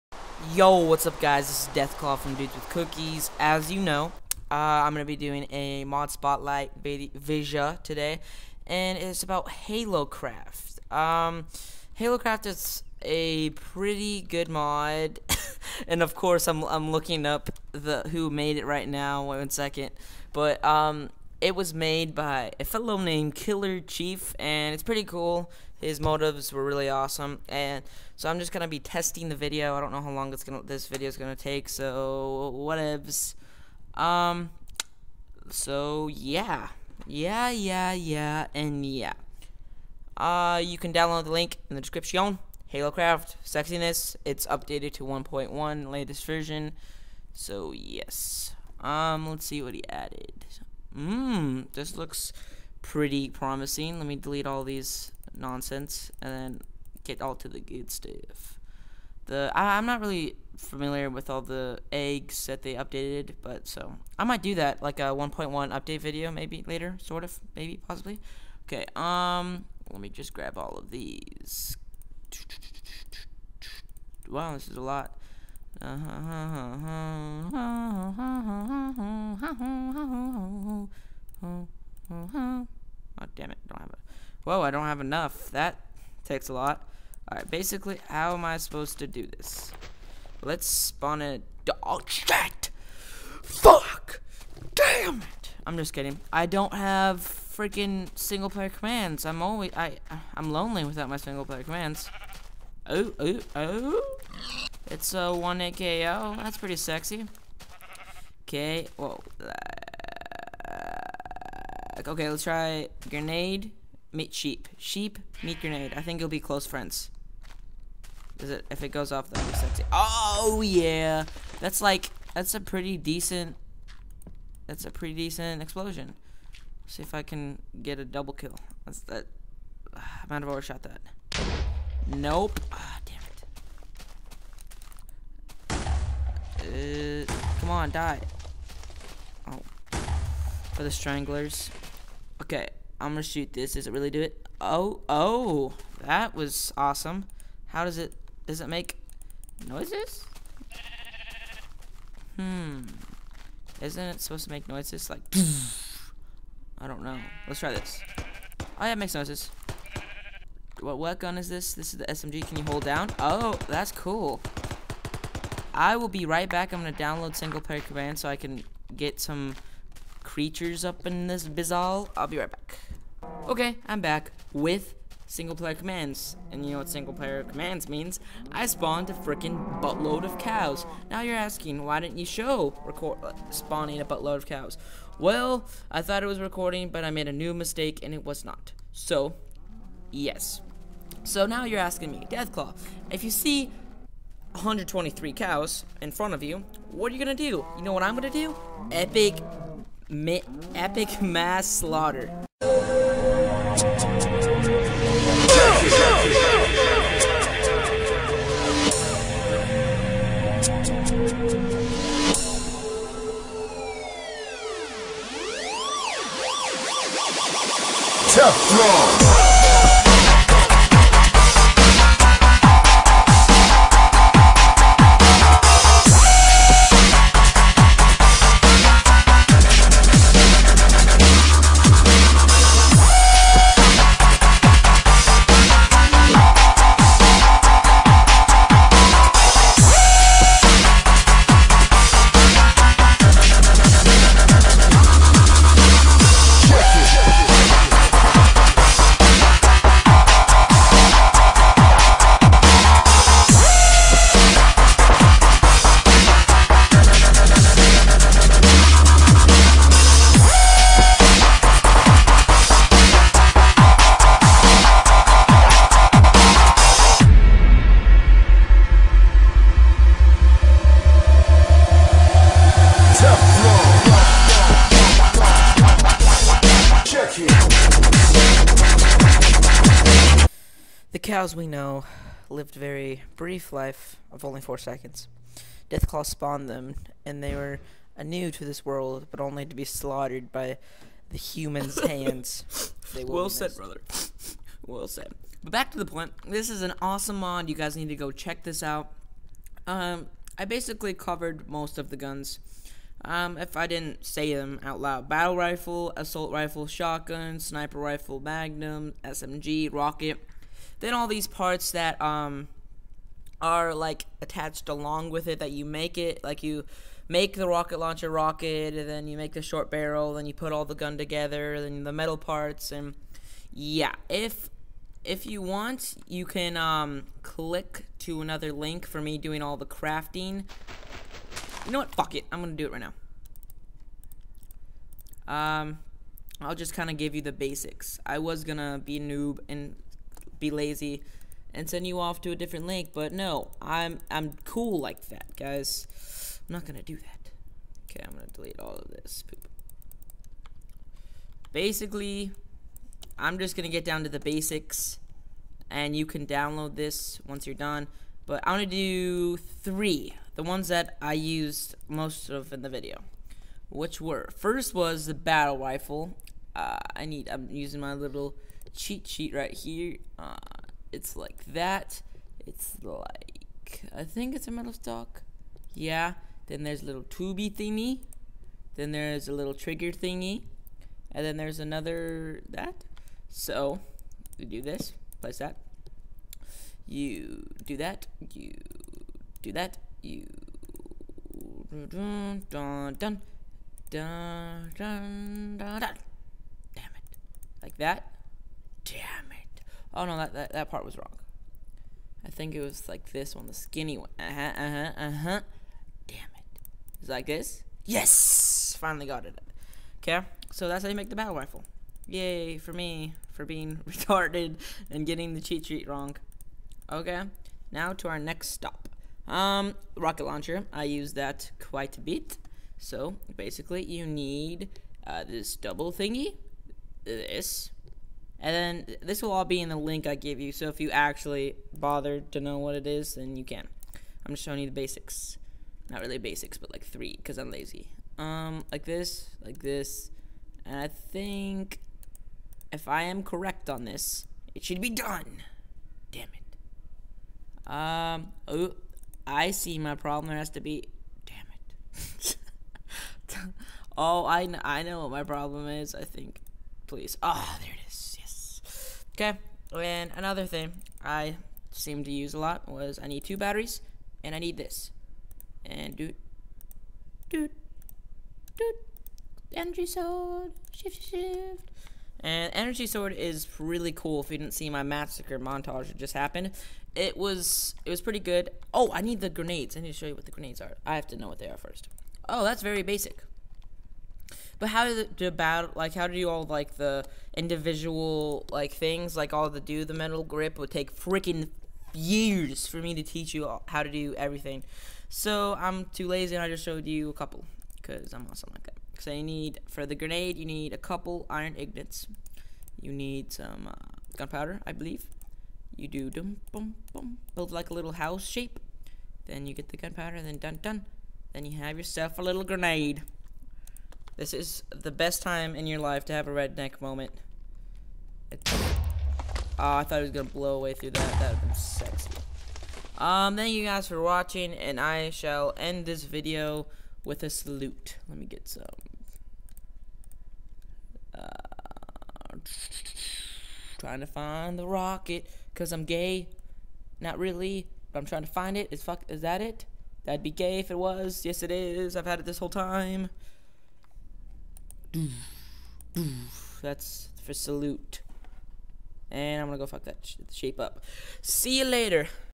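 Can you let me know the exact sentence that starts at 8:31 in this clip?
Then you have yourself a little grenade.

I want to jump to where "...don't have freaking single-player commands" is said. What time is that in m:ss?
1:36.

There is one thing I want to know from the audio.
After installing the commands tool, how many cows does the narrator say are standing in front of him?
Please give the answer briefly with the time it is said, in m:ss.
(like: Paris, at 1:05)
123, at 3:14.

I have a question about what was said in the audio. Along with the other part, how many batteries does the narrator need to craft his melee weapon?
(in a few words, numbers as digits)
2.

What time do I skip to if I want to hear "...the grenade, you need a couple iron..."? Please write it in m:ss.
8:20.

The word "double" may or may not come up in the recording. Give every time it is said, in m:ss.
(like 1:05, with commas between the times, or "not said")
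2:08, 7:05.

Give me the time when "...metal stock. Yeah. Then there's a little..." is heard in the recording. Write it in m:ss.
6:14.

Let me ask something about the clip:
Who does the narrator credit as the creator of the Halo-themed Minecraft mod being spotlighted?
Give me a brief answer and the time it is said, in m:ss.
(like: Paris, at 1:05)
Killer Chief, at 0:23.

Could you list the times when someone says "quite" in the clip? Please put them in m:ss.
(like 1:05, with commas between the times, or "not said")
7:01.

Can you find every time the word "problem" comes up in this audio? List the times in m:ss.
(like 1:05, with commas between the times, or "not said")
7:30, 7:35.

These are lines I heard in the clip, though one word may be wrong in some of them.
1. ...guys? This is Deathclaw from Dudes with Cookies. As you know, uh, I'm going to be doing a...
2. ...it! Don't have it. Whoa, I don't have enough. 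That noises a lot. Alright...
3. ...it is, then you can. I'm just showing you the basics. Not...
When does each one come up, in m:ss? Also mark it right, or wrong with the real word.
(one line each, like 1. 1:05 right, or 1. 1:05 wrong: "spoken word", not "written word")
1. 0:01 right
2. 1:23 wrong: "takes", not "noises"
3. 7:12 right.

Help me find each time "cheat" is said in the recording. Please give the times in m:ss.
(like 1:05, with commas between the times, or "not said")
6:08, 6:55.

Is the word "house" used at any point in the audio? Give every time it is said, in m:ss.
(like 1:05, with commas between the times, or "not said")
8:28.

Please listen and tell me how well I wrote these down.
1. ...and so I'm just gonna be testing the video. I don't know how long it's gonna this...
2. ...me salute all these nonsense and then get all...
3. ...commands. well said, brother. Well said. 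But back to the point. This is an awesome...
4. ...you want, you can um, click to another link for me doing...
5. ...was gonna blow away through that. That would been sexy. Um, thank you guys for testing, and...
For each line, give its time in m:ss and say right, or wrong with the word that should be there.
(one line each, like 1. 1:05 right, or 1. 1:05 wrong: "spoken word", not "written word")
1. 0:27 right
2. 0:54 wrong: "delete", not "salute"
3. 4:52 wrong: "hands", not "commands"
4. 5:25 right
5. 8:40 wrong: "watching", not "testing".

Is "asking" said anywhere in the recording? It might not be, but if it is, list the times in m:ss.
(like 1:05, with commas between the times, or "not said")
3:01, 3:11.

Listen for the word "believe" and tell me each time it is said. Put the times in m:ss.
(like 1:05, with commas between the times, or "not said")
8:24.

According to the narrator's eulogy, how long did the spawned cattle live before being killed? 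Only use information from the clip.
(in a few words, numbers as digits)
Four seconds.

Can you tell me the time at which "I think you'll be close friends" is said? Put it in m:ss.
1:55.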